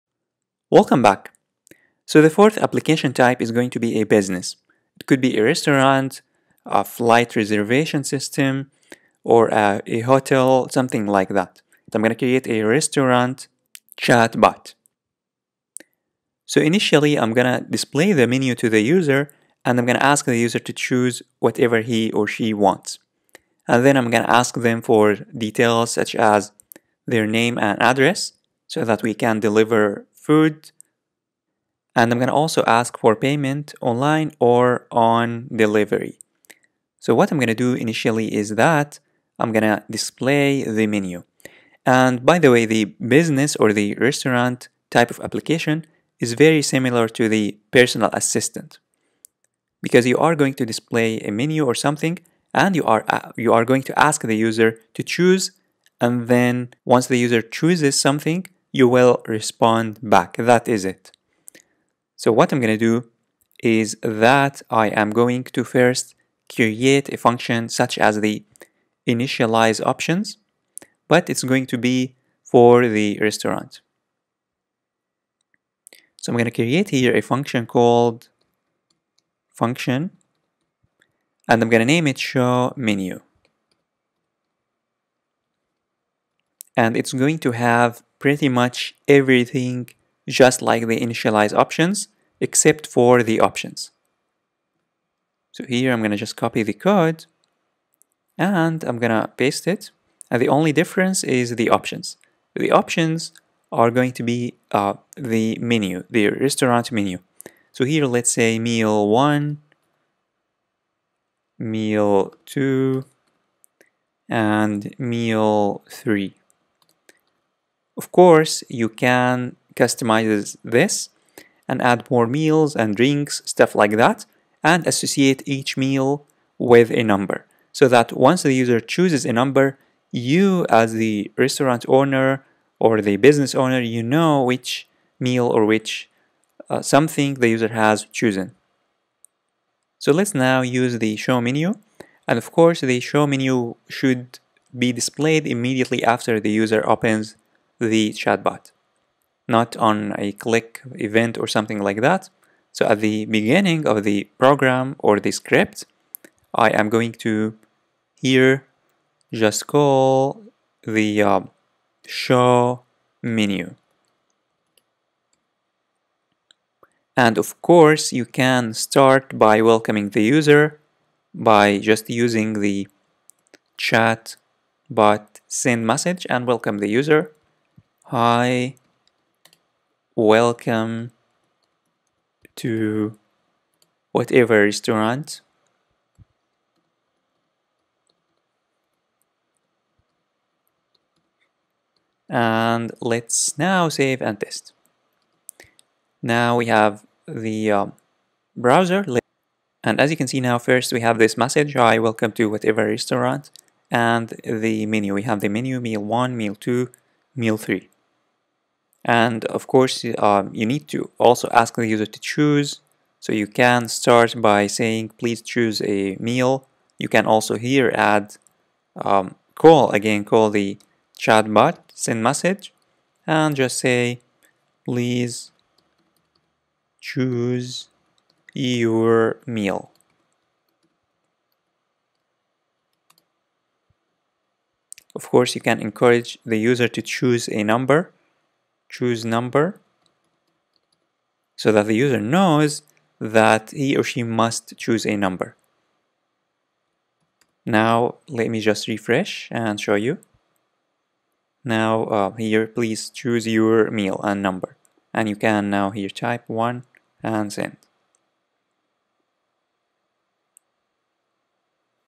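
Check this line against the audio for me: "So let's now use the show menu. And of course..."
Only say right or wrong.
right.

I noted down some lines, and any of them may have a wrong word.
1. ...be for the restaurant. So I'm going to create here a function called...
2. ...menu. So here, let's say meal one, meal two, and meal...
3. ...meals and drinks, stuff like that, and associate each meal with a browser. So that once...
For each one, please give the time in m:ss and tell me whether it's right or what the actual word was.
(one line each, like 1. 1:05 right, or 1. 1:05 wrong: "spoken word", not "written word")
1. 1:11 right
2. 1:46 right
3. 2:02 wrong: "number", not "browser".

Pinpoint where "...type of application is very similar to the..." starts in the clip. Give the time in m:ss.
0:44.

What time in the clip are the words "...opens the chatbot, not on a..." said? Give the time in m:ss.
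2:26.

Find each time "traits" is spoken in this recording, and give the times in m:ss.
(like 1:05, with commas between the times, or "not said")
not said.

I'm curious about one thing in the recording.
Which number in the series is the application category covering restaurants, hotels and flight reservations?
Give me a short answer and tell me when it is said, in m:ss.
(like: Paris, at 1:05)
fourth, at 0:02.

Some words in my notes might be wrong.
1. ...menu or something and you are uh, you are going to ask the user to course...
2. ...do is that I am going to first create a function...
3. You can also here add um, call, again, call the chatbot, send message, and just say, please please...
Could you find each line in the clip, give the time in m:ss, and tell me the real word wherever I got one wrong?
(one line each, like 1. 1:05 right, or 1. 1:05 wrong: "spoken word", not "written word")
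1. 0:51 wrong: "choose", not "course"
2. 1:02 right
3. 3:36 wrong: "choose", not "please".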